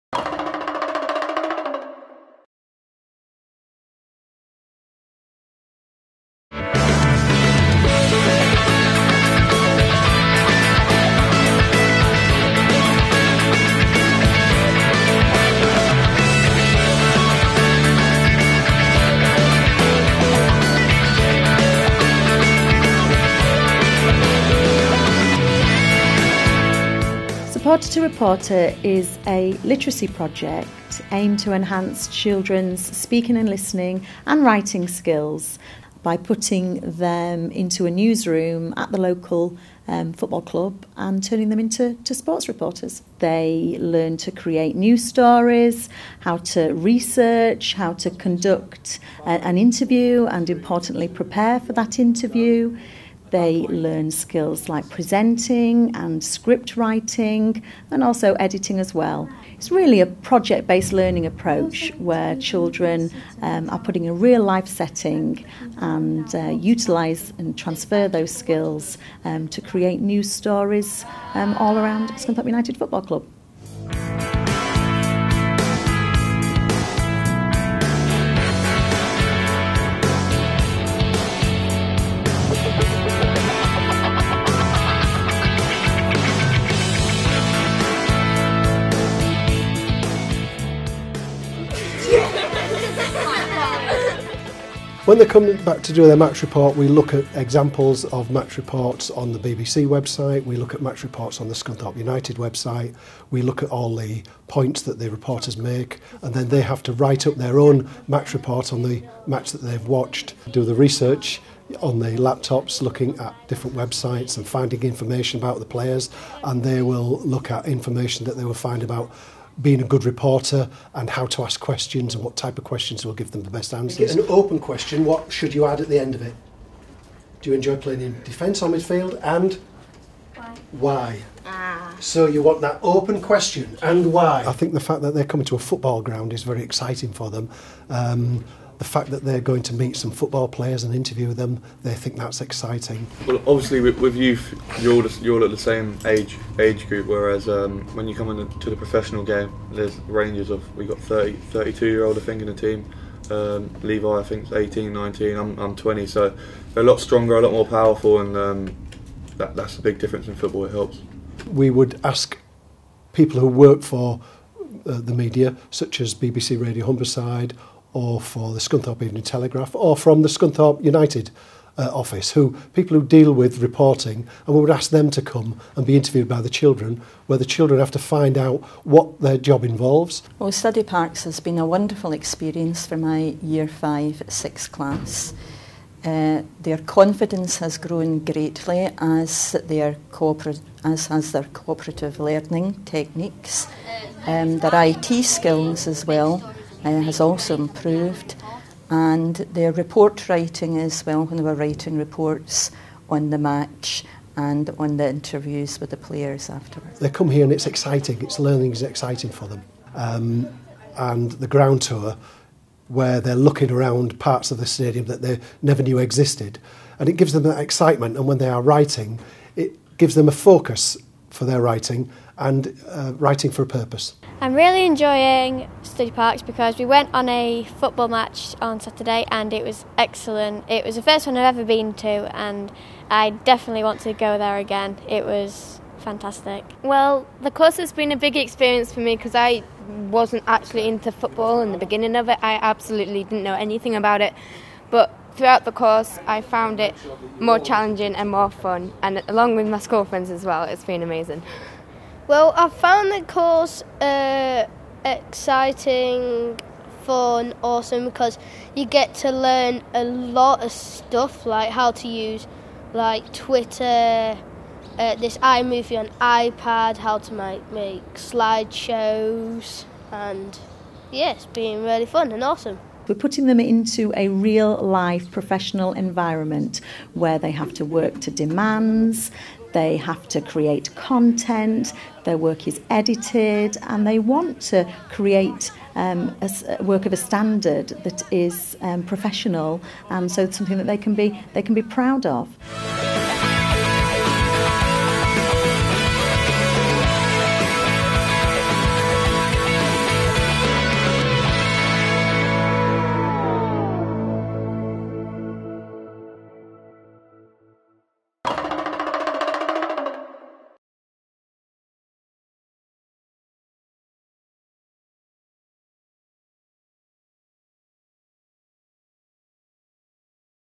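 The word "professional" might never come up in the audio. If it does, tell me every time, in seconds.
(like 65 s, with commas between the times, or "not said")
148 s, 275 s, 289 s.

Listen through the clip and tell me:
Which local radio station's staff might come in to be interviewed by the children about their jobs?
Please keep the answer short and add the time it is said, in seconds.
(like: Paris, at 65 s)
BBC Radio Humberside, at 166 s.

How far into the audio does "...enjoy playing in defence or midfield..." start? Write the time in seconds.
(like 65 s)
127 s.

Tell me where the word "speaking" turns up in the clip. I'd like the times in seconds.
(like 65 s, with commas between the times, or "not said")
32 s.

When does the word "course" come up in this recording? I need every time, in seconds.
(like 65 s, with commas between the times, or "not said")
237 s, 245 s, 253 s.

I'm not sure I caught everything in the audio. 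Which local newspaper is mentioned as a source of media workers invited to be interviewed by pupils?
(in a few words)
Scunthorpe Evening Telegraph.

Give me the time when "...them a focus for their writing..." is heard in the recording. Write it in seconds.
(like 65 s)
220 s.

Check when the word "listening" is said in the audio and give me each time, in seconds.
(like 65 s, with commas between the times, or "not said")
33 s.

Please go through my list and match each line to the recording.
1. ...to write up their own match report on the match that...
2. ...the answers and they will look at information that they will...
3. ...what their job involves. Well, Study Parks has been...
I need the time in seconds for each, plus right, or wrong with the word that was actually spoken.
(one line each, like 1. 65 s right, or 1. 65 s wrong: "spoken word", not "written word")
1. 106 s right
2. 115 s wrong: "players", not "answers"
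3. 178 s right.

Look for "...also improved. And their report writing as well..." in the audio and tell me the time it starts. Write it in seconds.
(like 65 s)
197 s.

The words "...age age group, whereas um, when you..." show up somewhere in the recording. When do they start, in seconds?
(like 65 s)
146 s.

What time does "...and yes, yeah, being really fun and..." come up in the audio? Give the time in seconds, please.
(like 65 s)
270 s.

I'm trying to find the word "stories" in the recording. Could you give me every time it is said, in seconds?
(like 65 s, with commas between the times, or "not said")
45 s, 70 s.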